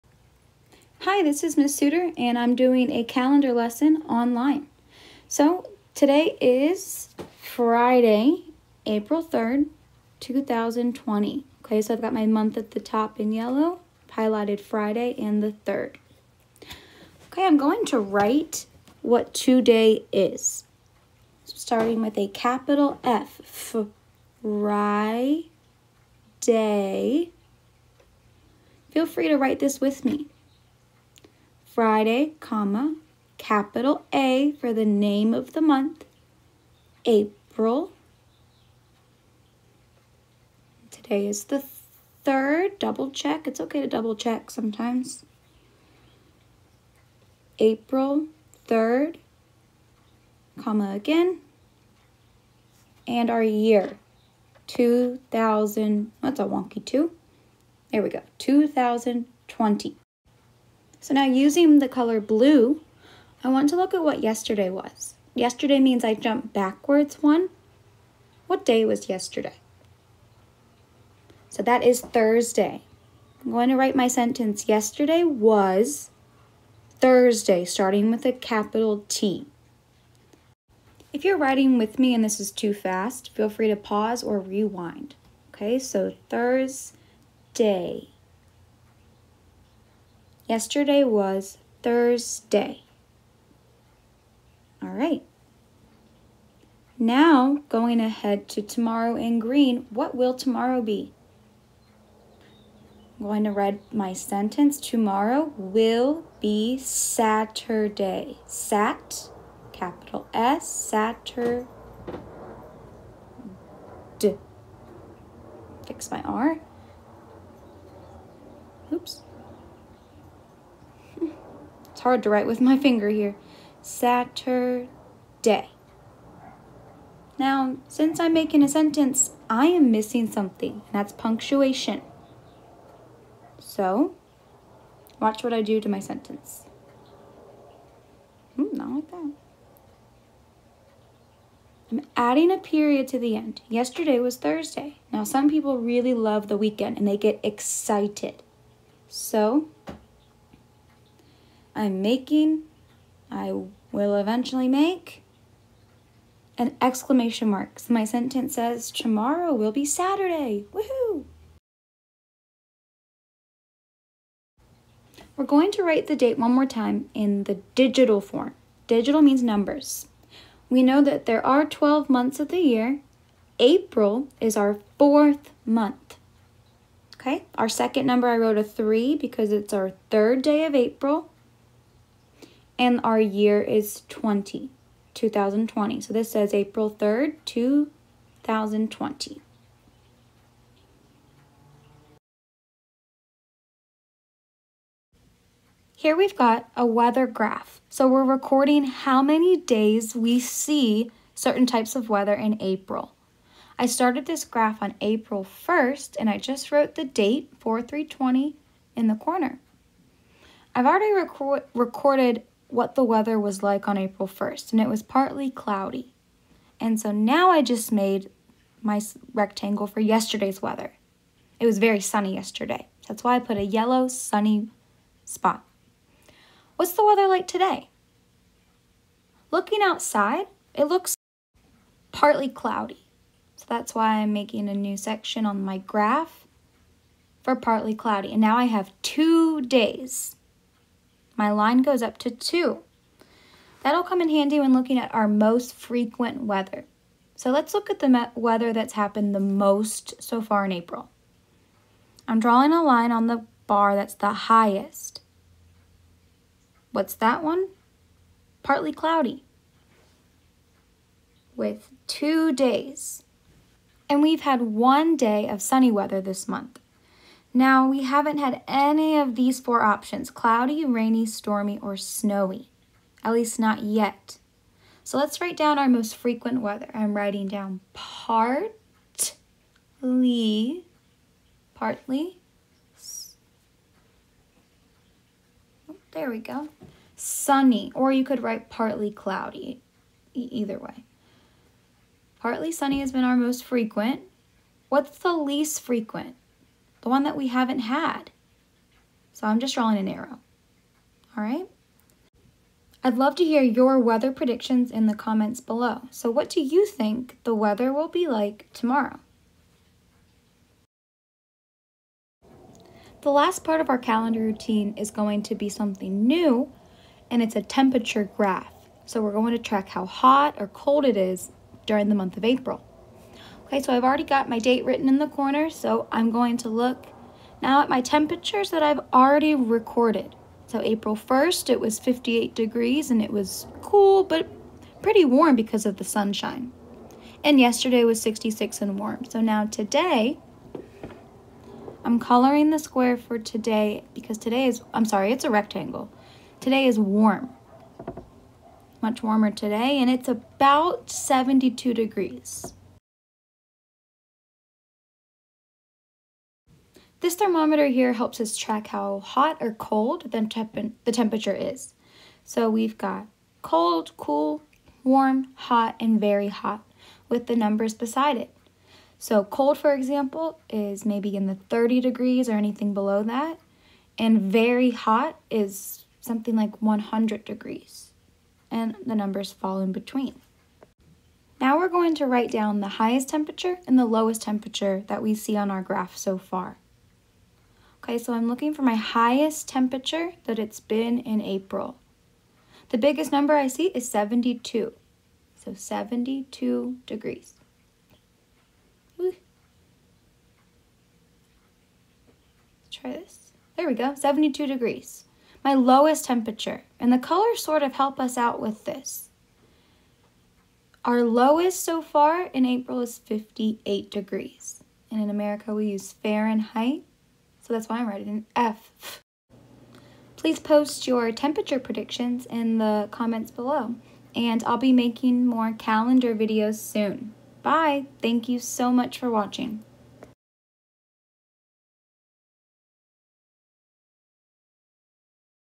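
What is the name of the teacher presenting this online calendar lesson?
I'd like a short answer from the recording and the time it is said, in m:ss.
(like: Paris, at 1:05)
Ms. Soutar, at 0:01.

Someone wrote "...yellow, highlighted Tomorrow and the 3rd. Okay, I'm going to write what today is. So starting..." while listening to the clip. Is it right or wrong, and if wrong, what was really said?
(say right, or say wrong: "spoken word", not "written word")
wrong: "Friday", not "Tomorrow".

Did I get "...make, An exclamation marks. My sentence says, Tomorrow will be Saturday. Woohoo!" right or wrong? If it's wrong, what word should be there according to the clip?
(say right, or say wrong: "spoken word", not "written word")
right.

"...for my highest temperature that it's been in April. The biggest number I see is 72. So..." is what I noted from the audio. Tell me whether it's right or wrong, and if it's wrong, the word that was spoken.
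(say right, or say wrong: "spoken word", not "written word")
right.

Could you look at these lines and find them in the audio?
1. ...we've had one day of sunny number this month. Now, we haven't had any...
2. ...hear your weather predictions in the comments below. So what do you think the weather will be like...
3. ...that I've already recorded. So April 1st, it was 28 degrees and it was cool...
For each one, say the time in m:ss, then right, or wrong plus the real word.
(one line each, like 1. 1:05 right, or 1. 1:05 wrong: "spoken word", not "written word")
1. 4:24 wrong: "weather", not "number"
2. 5:03 right
3. 5:28 wrong: "58", not "28".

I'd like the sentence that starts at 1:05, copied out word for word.
Yesterday means I jumped backwards one.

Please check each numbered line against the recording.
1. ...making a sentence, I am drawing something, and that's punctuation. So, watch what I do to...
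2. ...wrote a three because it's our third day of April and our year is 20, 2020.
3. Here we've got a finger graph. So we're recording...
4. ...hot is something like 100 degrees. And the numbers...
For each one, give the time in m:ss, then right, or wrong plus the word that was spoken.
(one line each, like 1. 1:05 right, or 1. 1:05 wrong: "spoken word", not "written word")
1. 2:08 wrong: "missing", not "drawing"
2. 2:58 right
3. 3:15 wrong: "weather", not "finger"
4. 6:14 right.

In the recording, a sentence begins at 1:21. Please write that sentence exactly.
If you're writing with me and this is too fast, feel free to pause or rewind.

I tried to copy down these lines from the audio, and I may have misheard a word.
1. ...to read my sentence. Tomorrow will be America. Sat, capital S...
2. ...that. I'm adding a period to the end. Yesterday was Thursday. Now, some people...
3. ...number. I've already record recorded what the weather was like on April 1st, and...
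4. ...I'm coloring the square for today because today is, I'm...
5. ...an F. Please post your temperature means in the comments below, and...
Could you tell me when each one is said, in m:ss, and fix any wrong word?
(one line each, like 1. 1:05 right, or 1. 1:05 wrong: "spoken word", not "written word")
1. 1:43 wrong: "Saturday", not "America"
2. 2:19 right
3. 3:29 wrong: "corner", not "number"
4. 5:42 right
5. 6:58 wrong: "predictions", not "means".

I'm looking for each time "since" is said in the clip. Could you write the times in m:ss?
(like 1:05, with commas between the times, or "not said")
2:07.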